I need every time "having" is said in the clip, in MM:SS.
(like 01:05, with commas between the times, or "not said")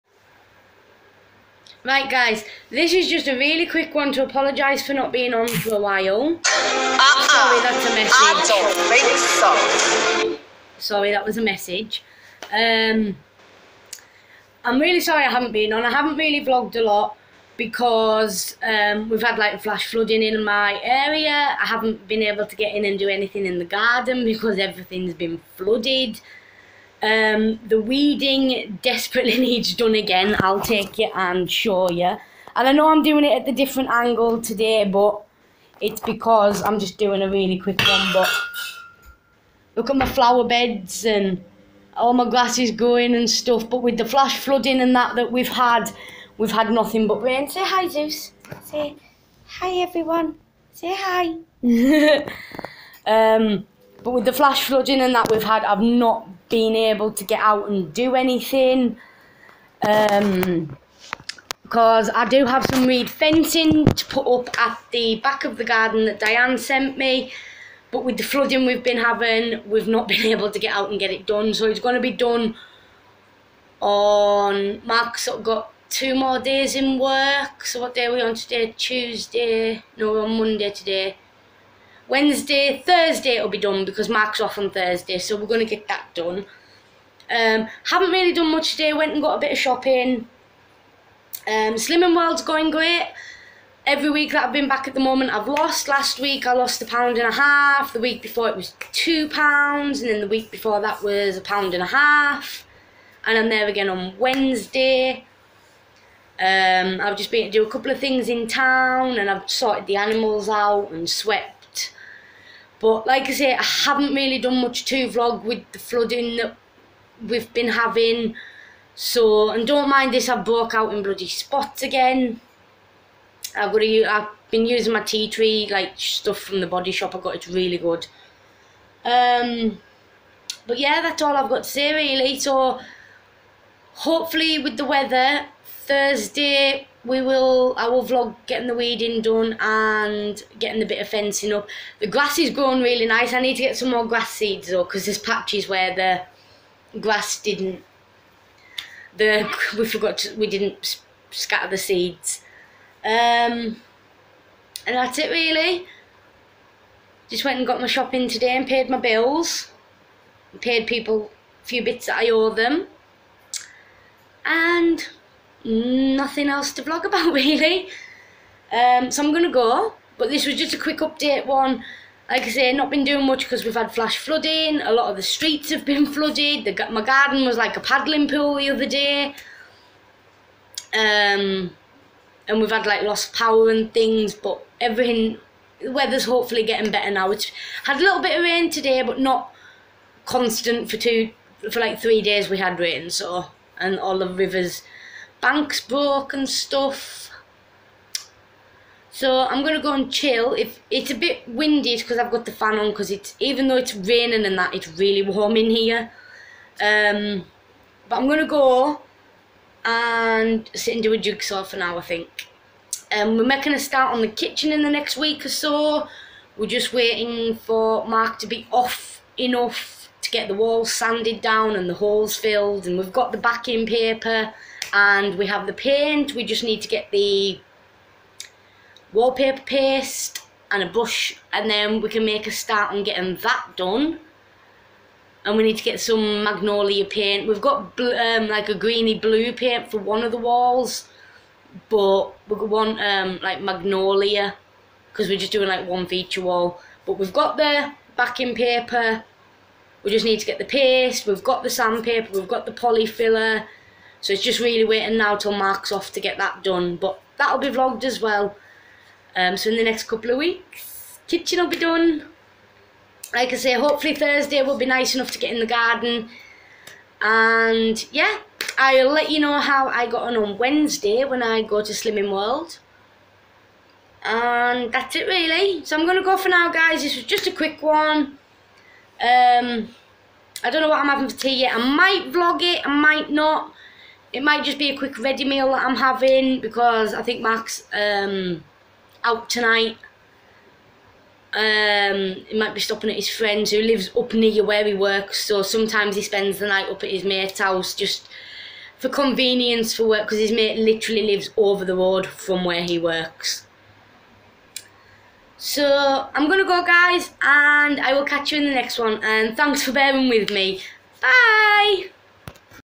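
01:08, 01:57, 04:41, 04:45.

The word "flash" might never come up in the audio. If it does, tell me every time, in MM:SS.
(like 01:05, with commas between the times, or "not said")
00:19, 00:44, 00:54, 02:53.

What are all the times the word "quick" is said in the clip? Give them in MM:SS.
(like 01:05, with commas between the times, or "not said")
00:03, 00:37, 02:50, 04:37, 04:44.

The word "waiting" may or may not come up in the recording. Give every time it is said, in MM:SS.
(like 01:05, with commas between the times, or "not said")
03:36, 04:14.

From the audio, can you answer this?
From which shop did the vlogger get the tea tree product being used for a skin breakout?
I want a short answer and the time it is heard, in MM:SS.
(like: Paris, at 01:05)
the Body Shop, at 02:06.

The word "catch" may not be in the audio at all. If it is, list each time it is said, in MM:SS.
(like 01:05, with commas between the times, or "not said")
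05:08.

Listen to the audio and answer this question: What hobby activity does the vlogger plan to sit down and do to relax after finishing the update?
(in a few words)
a jigsaw.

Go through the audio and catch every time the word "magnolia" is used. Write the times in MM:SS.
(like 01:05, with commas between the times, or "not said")
03:56, 04:03.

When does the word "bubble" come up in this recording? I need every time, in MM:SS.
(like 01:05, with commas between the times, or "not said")
not said.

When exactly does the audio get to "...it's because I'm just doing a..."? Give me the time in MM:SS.
00:35.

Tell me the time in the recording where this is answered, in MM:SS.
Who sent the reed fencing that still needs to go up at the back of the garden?
01:06.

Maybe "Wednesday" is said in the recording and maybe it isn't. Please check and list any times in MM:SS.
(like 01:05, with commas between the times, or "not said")
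01:22, 01:44, 04:30.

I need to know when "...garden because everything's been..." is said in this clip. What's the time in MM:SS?
00:23.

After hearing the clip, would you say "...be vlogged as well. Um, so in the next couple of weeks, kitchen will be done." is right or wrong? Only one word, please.
right.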